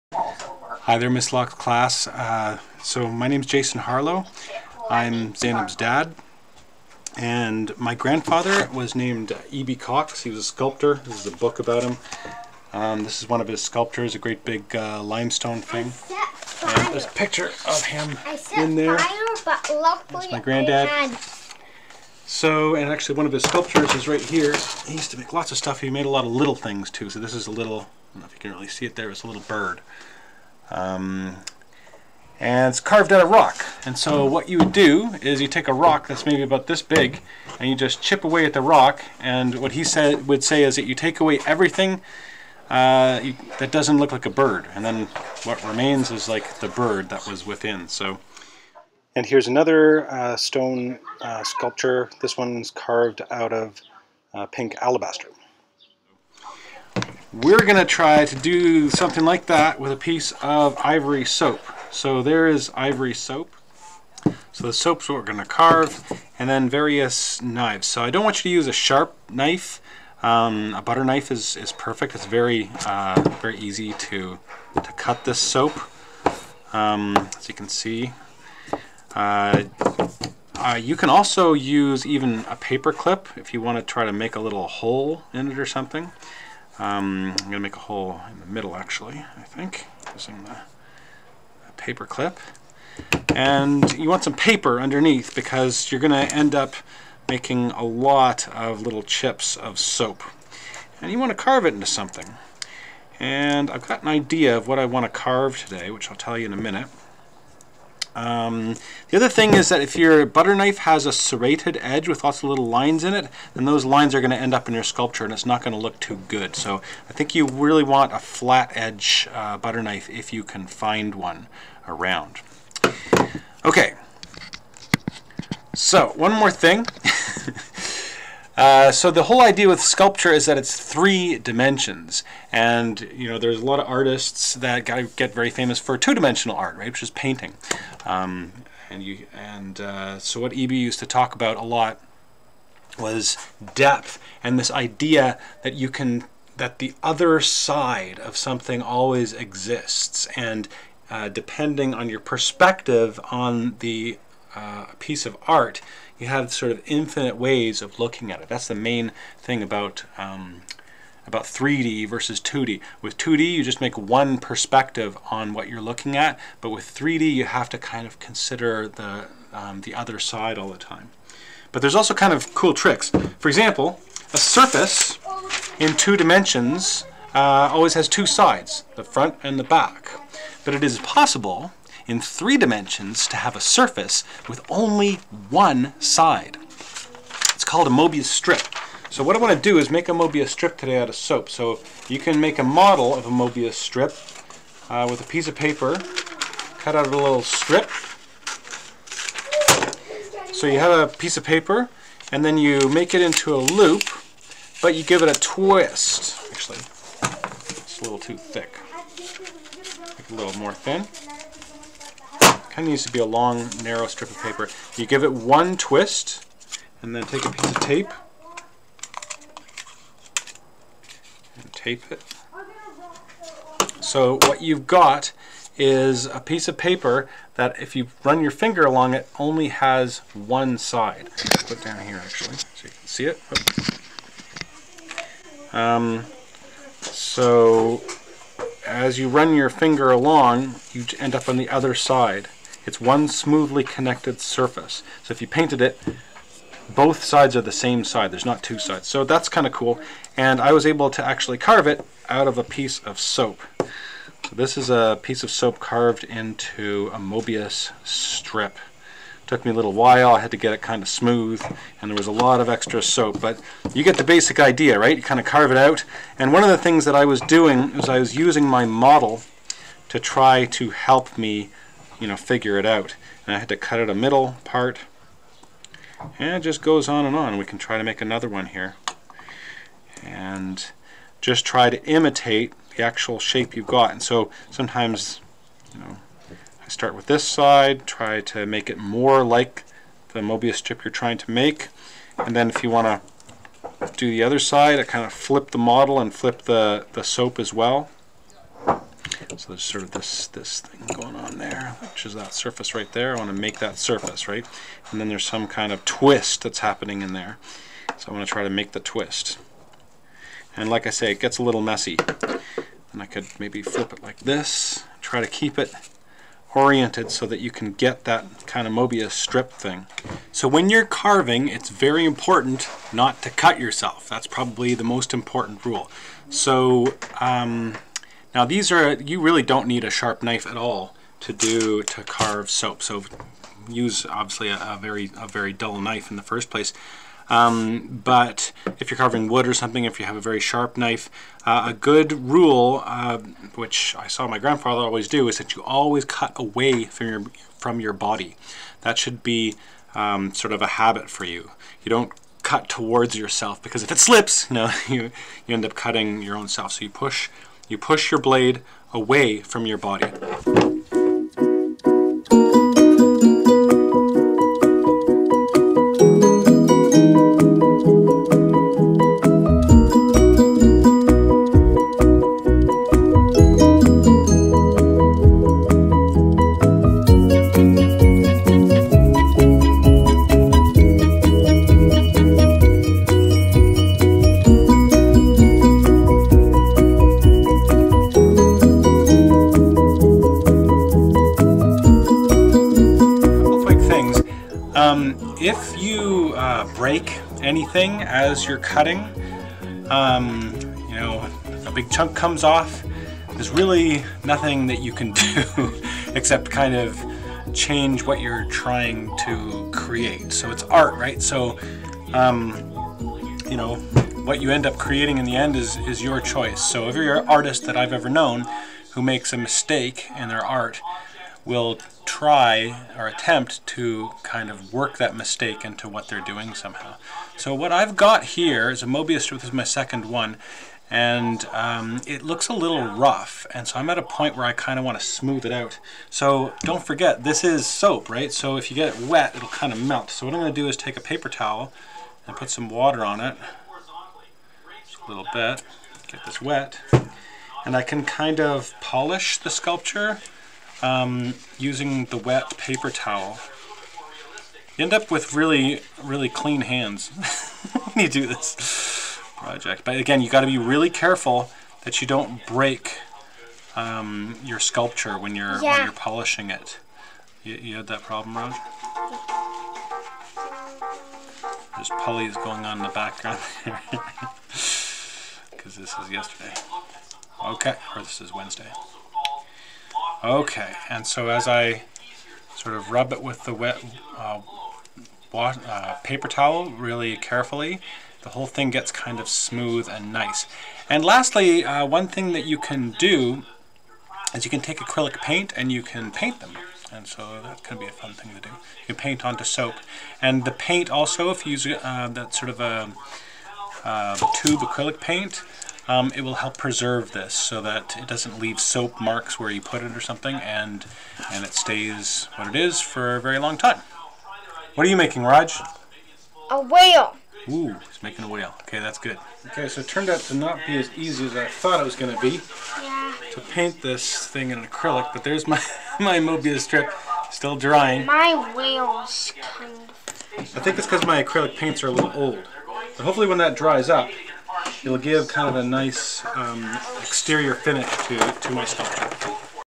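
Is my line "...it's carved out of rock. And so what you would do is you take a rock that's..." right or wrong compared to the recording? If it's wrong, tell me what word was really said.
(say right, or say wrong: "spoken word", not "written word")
right.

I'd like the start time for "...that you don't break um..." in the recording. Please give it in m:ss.
7:42.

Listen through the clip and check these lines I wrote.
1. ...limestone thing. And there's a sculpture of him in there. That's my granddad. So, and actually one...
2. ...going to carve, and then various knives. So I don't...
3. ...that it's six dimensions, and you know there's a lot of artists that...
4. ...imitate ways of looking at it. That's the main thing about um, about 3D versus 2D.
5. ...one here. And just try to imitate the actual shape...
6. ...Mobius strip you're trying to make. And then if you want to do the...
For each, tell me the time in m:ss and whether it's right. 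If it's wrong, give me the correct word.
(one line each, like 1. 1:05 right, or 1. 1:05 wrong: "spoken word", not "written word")
1. 0:15 wrong: "picture", not "sculpture"
2. 1:05 right
3. 2:10 wrong: "three", not "six"
4. 2:36 wrong: "infinite", not "imitate"
5. 4:38 right
6. 4:50 right.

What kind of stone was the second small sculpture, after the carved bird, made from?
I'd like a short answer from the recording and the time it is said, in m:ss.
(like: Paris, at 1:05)
Pink alabaster, at 0:54.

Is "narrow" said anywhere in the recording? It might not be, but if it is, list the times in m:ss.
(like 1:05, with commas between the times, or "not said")
3:33.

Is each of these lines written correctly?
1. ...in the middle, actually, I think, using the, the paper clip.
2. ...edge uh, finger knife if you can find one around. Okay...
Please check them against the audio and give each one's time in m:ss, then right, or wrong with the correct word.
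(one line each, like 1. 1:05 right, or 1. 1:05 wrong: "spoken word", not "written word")
1. 1:28 right
2. 1:58 wrong: "butter", not "finger".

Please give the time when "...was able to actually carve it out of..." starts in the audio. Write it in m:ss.
4:10.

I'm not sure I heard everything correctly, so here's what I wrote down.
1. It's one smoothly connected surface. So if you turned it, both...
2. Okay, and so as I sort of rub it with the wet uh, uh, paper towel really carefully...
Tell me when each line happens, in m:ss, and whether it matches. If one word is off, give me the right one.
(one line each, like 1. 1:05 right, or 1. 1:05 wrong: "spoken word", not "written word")
1. 4:02 wrong: "painted", not "turned"
2. 8:00 right.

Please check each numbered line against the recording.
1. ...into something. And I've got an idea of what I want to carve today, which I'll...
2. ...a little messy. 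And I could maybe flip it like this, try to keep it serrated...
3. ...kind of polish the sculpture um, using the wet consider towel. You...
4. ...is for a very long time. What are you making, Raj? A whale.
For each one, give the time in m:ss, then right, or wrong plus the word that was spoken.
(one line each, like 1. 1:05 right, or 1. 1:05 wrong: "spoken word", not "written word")
1. 1:41 right
2. 5:11 wrong: "oriented", not "serrated"
3. 7:28 wrong: "paper", not "consider"
4. 8:32 right.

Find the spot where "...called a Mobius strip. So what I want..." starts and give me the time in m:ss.
3:07.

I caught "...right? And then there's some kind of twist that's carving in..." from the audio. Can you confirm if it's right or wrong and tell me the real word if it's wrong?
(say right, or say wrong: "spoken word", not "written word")
wrong: "happening", not "carving".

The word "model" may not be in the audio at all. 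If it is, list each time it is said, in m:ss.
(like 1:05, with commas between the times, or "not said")
3:12, 4:28, 4:55.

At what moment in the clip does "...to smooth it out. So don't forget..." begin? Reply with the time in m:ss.
7:15.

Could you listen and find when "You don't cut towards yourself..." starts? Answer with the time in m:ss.
5:52.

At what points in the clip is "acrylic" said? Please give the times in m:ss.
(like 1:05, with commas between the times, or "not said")
8:14, 8:24, 8:44, 8:51.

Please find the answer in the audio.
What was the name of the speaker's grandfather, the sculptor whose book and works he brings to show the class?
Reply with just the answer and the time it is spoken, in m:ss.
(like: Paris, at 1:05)
E.B. Cox, at 0:09.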